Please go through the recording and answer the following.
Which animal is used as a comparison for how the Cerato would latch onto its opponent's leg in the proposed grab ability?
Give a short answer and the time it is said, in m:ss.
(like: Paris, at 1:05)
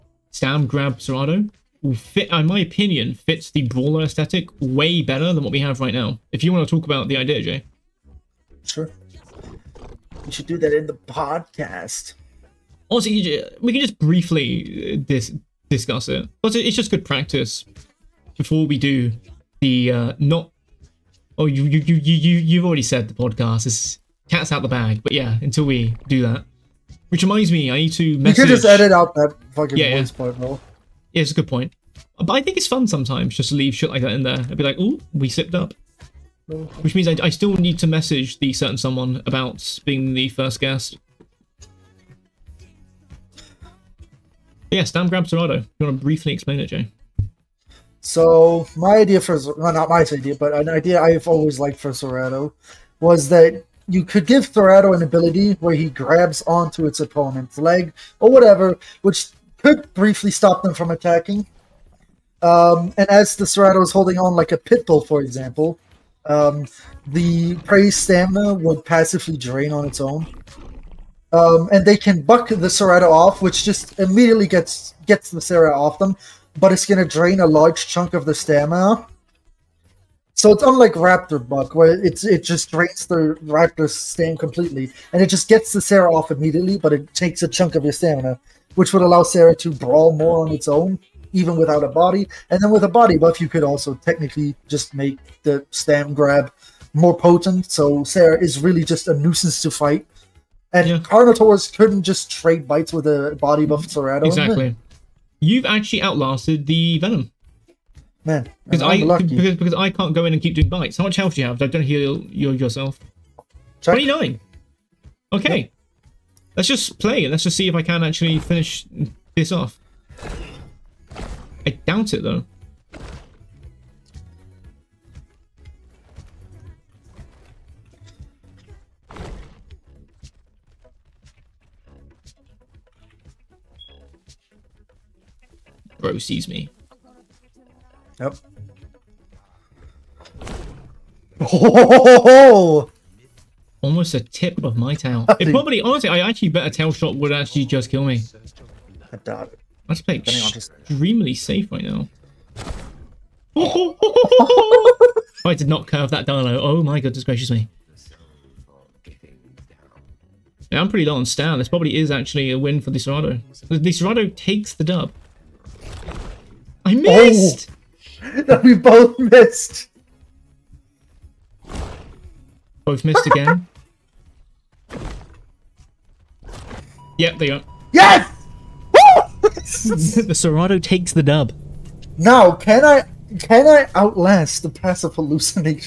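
Pit bull, at 1:04.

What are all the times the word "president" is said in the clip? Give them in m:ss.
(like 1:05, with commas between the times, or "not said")
not said.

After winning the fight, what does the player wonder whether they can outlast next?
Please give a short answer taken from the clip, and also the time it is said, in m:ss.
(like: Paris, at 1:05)
Passive hallucinations, at 3:04.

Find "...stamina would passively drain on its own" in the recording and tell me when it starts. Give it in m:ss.
1:07.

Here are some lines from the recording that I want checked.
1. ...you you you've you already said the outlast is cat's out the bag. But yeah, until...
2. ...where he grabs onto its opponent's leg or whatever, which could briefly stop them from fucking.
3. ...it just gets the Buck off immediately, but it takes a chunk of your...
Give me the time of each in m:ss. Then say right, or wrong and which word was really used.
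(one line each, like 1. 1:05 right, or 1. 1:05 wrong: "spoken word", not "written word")
1. 0:21 wrong: "podcast", not "outlast"
2. 0:55 wrong: "attacking", not "fucking"
3. 1:25 wrong: "Cera", not "Buck".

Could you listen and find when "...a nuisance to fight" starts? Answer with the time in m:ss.
1:39.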